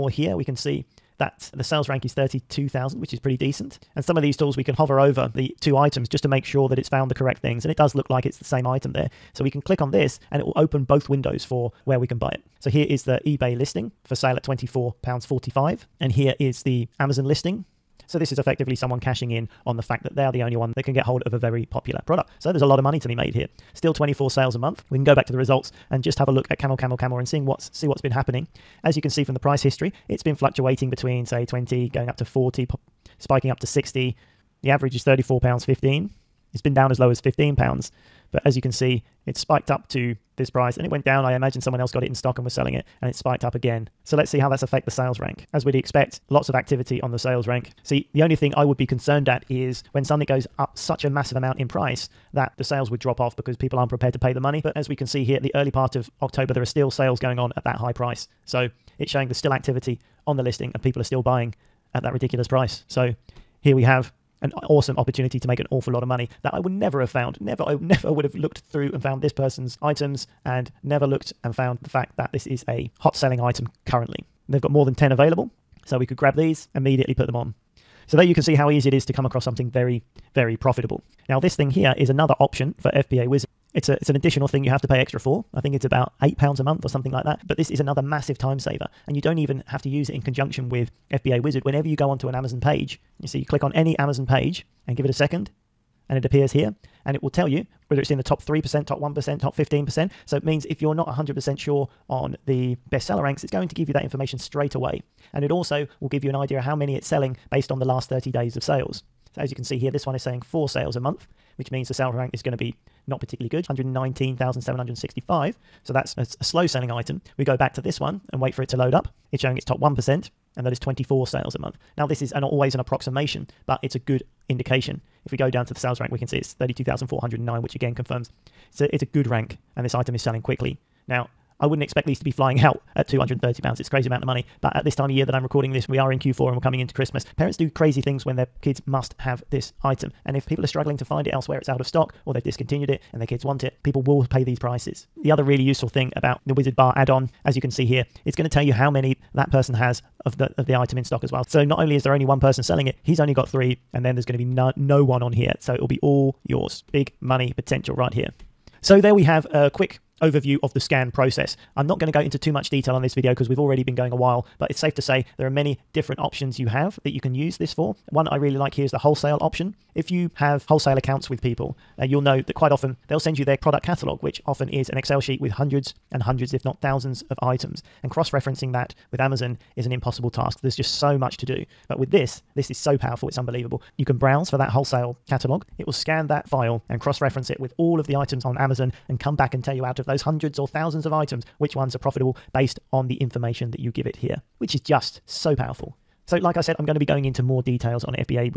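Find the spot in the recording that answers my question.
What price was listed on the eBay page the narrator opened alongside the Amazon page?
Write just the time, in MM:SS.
00:14.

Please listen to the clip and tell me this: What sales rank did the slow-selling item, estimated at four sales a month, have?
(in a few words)
119,765.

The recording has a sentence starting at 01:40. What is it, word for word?
So it means if you're not 100% sure on the bestseller ranks, it's going to give you that information straight away.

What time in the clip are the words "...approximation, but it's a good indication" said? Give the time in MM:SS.
02:02.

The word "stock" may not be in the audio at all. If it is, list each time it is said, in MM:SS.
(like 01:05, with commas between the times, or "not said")
00:42, 02:21, 02:31.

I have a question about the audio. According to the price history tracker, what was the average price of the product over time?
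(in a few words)
34 pounds 15.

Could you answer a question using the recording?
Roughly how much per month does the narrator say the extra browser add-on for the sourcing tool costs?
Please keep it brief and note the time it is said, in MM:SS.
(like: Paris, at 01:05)
8 pounds, at 01:26.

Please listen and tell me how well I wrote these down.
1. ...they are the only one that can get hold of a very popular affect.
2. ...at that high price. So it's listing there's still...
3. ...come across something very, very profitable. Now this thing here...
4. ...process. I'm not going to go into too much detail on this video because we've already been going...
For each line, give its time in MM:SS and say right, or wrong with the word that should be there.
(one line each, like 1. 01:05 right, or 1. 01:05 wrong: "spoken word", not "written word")
1. 00:20 wrong: "product", not "affect"
2. 00:57 wrong: "showing", not "listing"
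3. 01:19 right
4. 02:41 right.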